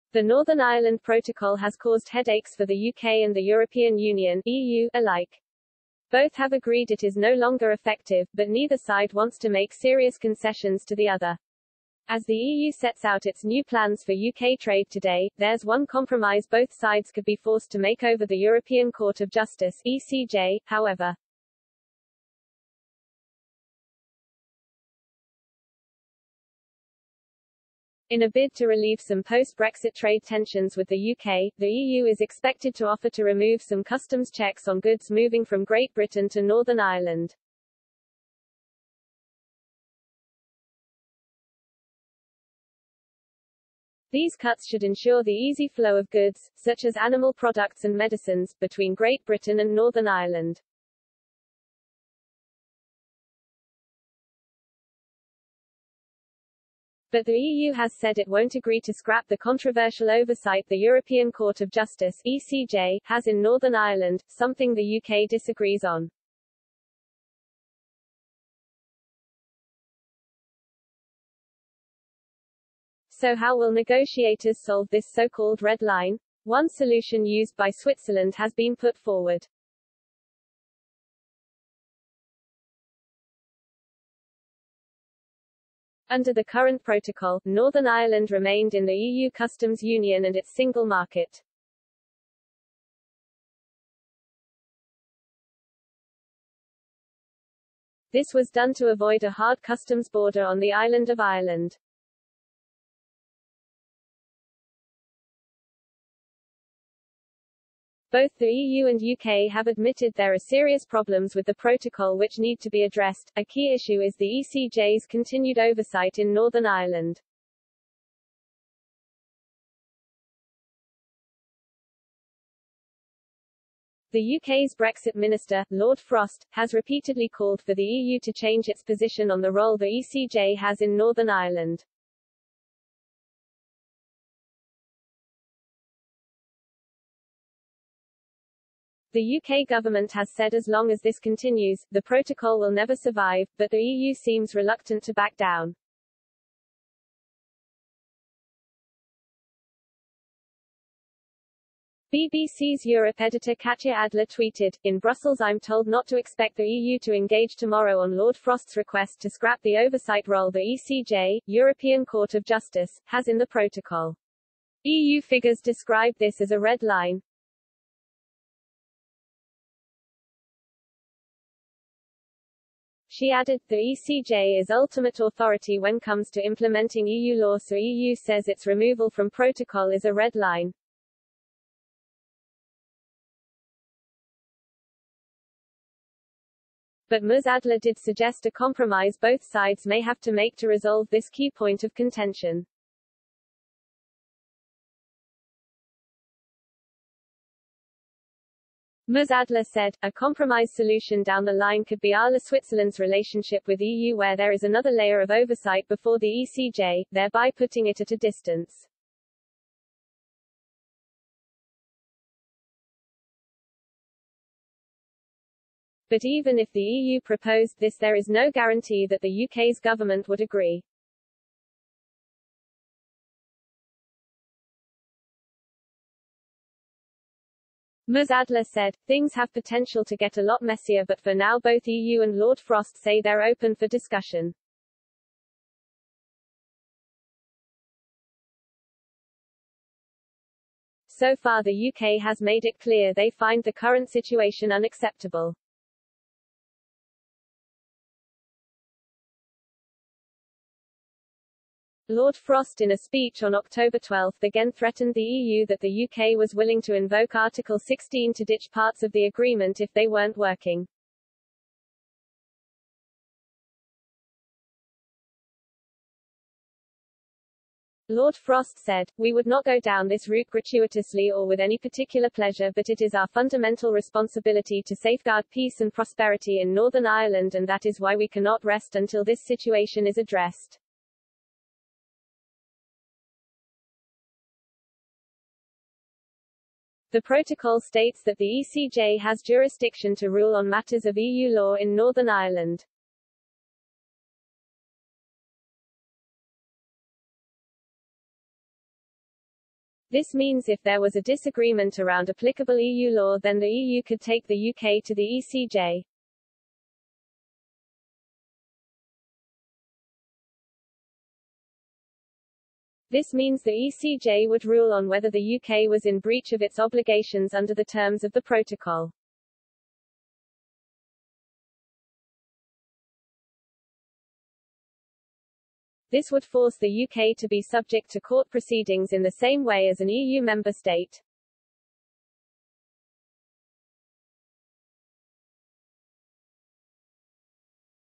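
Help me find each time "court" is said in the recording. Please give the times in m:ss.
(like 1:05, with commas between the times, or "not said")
0:18, 1:01, 2:42, 5:28.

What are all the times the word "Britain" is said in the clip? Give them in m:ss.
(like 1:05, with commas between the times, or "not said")
0:35, 0:49.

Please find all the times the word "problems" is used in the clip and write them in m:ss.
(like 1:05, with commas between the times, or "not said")
1:50.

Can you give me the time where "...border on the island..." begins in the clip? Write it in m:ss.
1:40.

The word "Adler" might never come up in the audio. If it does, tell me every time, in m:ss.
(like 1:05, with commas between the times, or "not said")
2:33, 3:07, 3:19, 3:48.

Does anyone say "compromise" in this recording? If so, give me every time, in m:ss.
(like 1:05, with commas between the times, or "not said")
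0:15, 3:08, 3:20.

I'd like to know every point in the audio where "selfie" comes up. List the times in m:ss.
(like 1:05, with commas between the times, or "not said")
not said.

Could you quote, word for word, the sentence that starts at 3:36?
But even if the EU proposed this there is no guarantee that the UK's government would agree.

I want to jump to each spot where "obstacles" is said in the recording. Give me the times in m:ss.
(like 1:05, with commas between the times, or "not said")
not said.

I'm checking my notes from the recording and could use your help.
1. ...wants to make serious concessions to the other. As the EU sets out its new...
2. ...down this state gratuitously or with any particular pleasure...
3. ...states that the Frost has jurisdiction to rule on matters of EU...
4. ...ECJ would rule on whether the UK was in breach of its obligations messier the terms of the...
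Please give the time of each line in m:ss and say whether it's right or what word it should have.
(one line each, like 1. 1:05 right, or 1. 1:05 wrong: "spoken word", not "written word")
1. 0:09 right
2. 4:29 wrong: "route", not "state"
3. 4:47 wrong: "ECJ", not "Frost"
4. 5:13 wrong: "under", not "messier".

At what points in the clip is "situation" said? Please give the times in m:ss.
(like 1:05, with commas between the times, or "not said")
4:04, 4:39.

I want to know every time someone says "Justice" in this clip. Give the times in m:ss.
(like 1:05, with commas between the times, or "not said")
0:19, 1:01, 2:42.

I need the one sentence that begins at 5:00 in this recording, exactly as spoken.
This means if there was a disagreement around applicable EU law then the EU could take the UK to the ECJ.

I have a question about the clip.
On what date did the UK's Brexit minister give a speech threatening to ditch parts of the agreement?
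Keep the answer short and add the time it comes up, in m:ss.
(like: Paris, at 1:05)
October 12, at 4:13.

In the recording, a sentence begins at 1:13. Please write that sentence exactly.
So how will negotiators solve this so-called red line?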